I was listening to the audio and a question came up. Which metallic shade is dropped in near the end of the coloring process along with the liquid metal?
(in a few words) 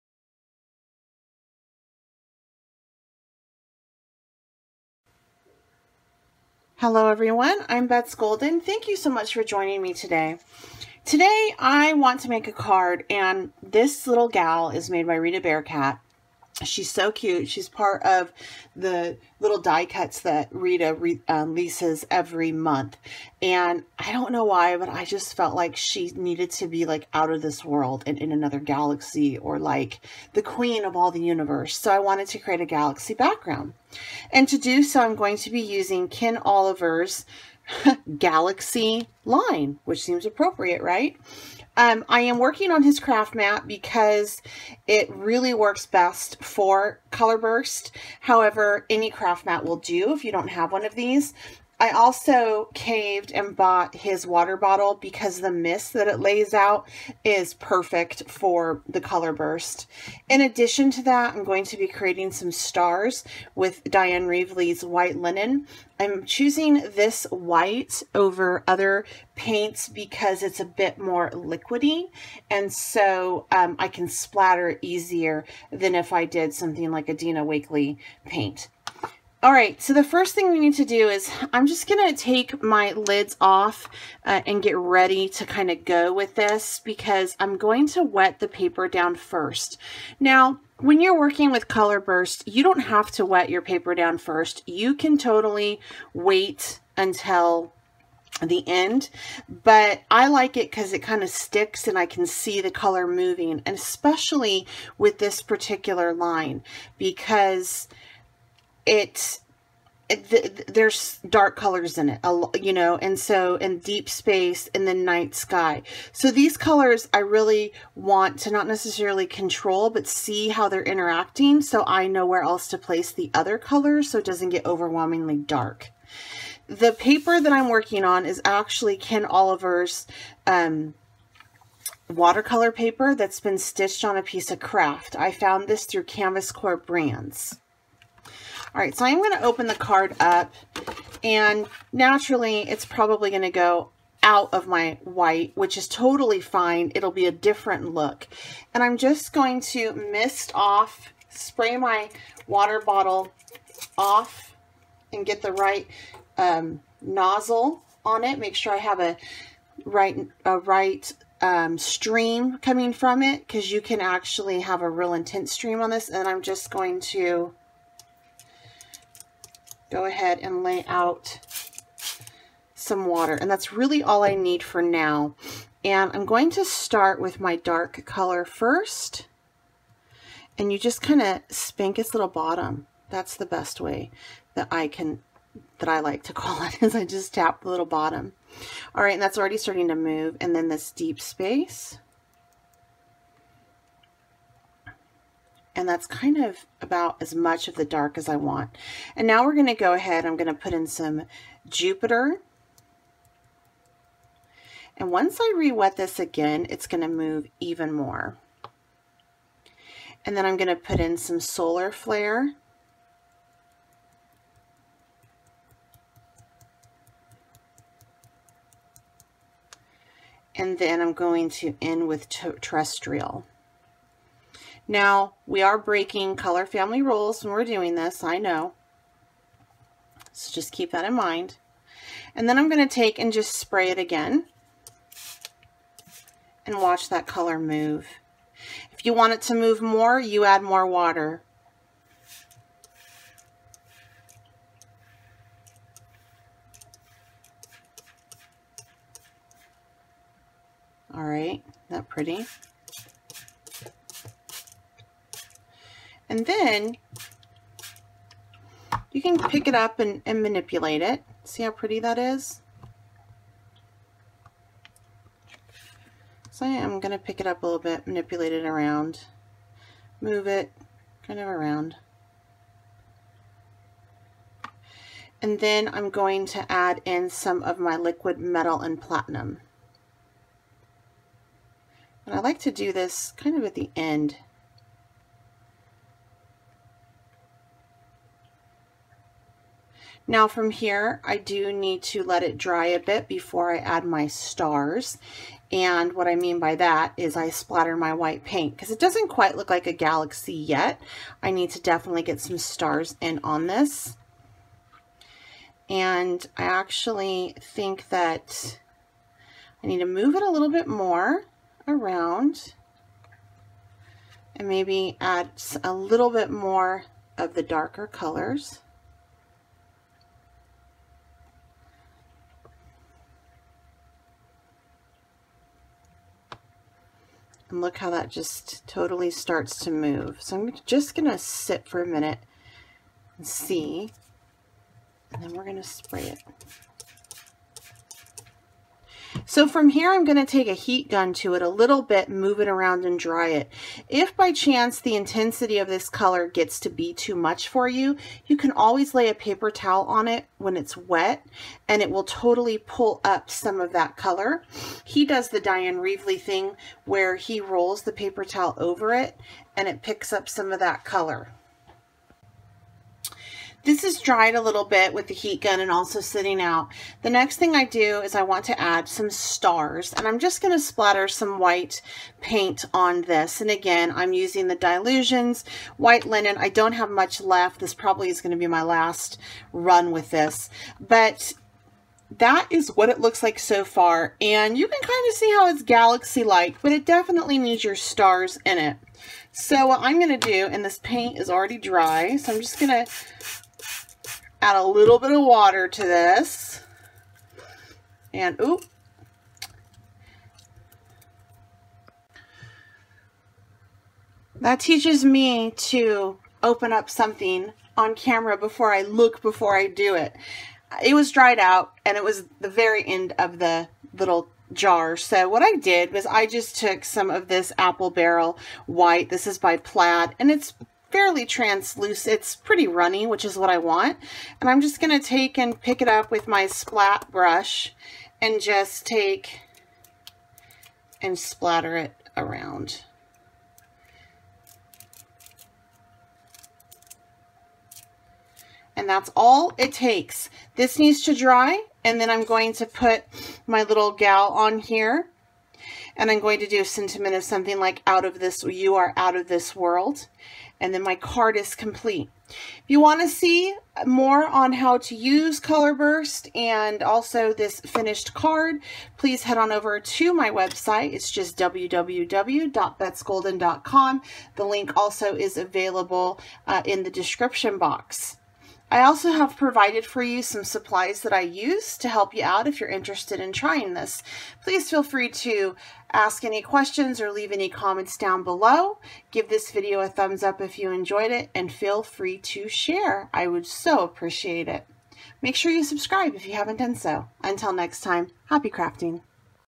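platinum.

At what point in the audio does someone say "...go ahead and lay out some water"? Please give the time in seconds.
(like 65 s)
169 s.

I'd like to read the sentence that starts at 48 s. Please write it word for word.
However, any craft mat will do if you don't have one of these.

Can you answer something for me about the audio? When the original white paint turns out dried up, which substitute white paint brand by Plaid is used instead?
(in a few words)
Apple Barrel.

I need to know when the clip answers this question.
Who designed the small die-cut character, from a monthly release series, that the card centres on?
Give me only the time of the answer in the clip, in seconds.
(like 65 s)
15 s.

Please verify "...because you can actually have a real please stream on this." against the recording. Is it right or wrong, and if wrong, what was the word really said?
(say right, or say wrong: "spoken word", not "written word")
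wrong: "intense", not "please".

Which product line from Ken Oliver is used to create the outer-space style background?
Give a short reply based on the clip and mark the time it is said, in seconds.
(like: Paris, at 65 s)
galaxy line, at 38 s.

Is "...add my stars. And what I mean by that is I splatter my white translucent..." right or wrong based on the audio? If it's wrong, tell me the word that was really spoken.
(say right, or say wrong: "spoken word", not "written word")
wrong: "paint", not "translucent".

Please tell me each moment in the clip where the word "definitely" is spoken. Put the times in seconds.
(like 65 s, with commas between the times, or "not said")
301 s, 387 s.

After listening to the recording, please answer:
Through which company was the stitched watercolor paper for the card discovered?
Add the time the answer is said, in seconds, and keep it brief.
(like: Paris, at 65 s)
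Canvas Corp Brands, at 136 s.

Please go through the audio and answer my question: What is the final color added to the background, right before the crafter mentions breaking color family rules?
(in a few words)
terrestrial.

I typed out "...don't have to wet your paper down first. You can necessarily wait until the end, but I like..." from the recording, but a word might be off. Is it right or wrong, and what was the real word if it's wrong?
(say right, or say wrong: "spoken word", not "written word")
wrong: "totally", not "necessarily".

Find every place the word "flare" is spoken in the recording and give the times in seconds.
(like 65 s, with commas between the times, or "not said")
211 s.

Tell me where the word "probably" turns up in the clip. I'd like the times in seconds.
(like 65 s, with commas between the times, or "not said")
142 s, 377 s.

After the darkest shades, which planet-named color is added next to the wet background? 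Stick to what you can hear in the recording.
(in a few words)
Jupiter.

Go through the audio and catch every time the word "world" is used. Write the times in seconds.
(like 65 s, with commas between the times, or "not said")
27 s, 449 s.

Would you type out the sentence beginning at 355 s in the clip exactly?
He does the Dyan Reaveley thing where he rolls the paper towel over it and it picks up some of that color.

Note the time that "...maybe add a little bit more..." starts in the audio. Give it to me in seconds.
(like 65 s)
314 s.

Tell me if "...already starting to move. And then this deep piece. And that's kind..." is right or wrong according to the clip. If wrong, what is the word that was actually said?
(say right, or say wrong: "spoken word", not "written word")
wrong: "space", not "piece".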